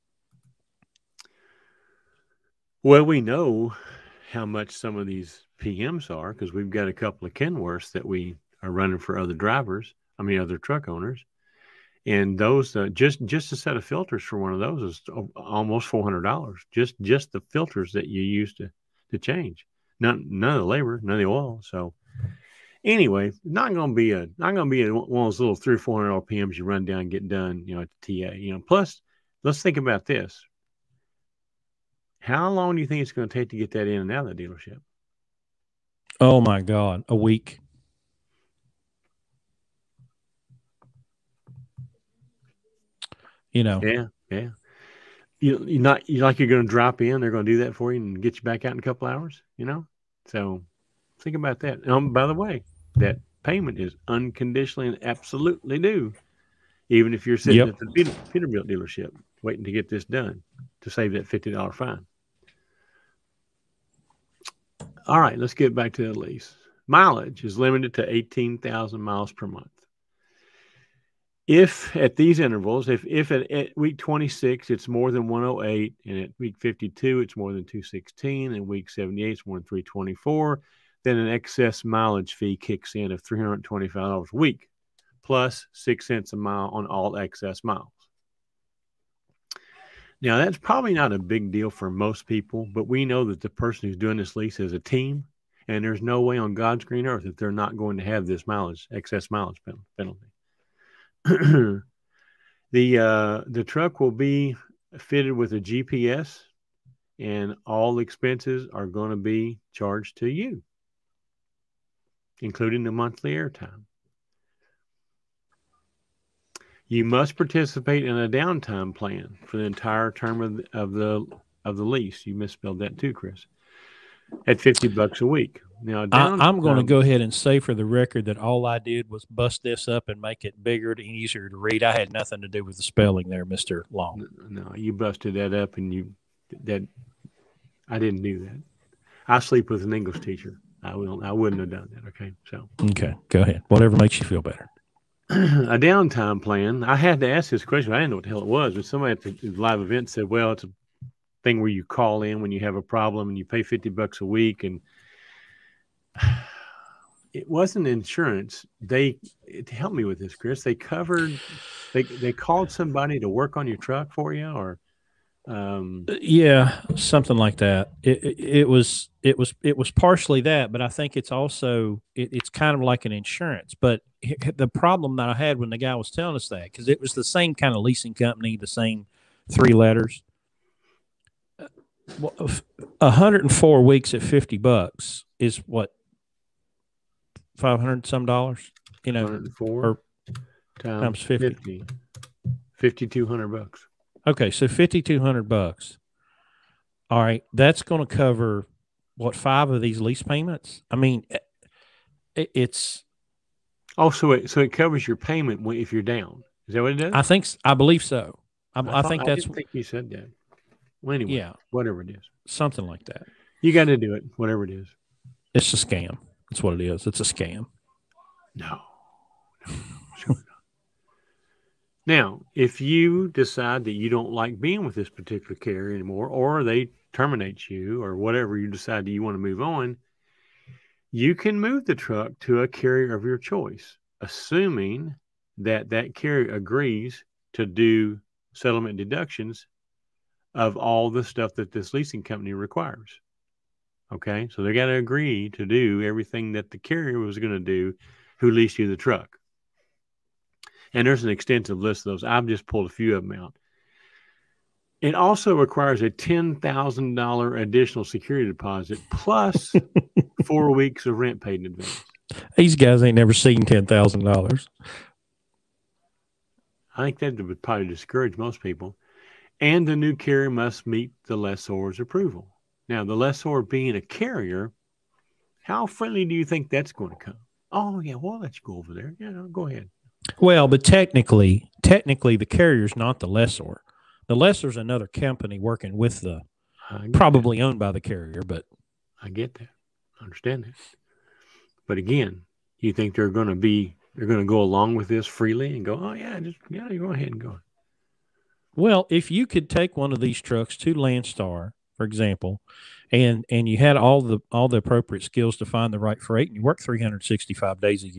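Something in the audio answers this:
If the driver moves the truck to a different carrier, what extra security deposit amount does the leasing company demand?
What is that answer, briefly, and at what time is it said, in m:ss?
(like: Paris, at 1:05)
$10,000, at 4:16.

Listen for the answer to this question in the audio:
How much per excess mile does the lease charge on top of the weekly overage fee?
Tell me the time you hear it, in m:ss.
1:25.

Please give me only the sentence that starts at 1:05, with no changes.
All right, let's get back to the lease.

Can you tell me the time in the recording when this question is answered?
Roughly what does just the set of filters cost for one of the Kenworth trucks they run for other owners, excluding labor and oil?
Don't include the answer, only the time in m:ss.
0:15.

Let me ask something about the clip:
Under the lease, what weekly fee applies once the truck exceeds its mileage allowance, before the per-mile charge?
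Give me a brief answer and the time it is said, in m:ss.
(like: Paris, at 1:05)
$325, at 1:23.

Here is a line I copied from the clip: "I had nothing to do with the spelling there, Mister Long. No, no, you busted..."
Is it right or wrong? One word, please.
right.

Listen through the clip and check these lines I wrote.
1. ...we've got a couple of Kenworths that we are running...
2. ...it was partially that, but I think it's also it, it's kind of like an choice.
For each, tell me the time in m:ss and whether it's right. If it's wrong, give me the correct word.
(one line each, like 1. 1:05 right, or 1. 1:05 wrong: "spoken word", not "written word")
1. 0:06 right
2. 2:49 wrong: "insurance", not "choice".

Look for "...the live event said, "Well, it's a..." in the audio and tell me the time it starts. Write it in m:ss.
2:29.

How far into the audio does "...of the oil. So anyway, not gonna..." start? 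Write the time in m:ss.
0:21.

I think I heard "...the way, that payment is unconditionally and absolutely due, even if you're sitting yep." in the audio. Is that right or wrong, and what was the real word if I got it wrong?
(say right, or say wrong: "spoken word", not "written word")
right.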